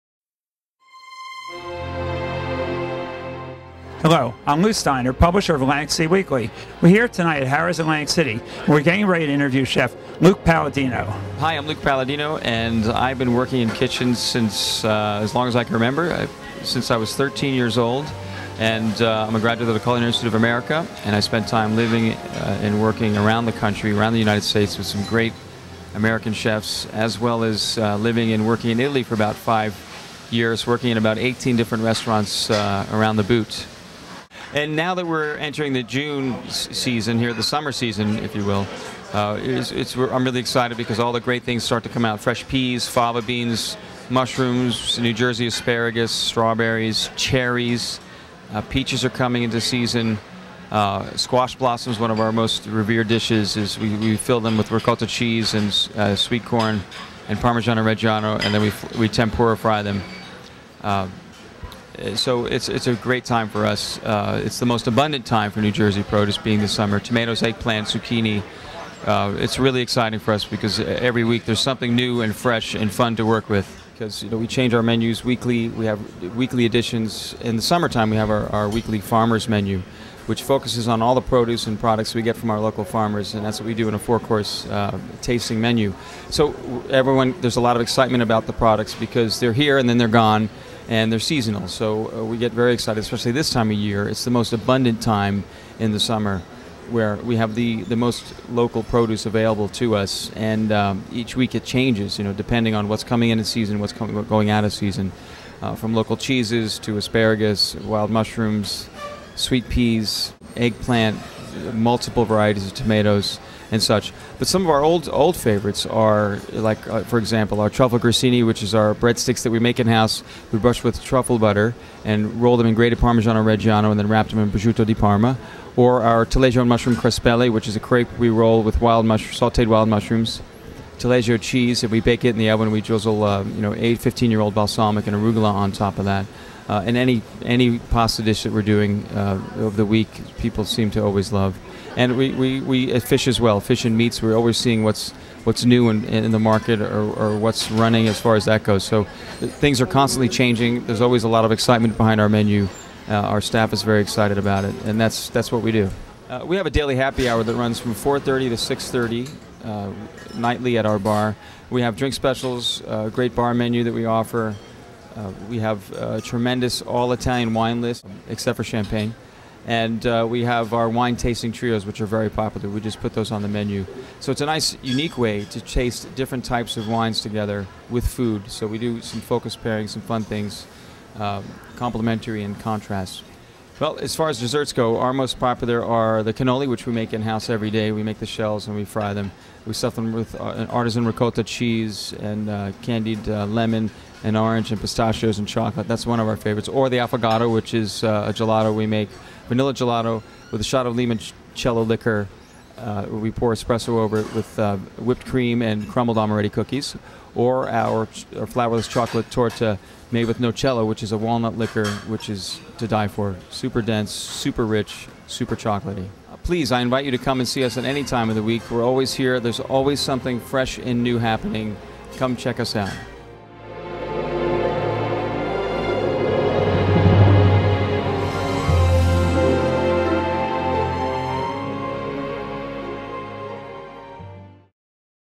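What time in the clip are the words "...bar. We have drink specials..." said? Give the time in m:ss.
2:40.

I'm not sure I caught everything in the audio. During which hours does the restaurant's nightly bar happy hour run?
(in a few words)
4:30 to 6:30.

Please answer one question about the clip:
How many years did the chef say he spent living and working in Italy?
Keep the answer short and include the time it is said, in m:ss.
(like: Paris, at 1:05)
5, at 0:29.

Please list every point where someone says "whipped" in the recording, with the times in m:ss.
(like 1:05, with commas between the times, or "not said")
3:24.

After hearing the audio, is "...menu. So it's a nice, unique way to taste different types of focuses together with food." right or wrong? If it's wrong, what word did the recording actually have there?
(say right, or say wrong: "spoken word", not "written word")
wrong: "wines", not "focuses".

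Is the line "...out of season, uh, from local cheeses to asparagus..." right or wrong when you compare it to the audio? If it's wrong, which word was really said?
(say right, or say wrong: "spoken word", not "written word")
right.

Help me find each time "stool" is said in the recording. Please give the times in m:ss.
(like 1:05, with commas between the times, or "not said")
not said.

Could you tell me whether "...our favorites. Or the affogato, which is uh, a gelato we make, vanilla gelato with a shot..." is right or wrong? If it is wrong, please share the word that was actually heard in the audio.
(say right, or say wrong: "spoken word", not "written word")
right.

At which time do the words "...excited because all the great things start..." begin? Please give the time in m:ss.
0:40.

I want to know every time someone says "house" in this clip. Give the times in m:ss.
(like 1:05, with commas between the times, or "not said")
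1:59, 3:07.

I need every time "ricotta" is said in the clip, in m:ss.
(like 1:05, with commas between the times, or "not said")
0:54, 3:11.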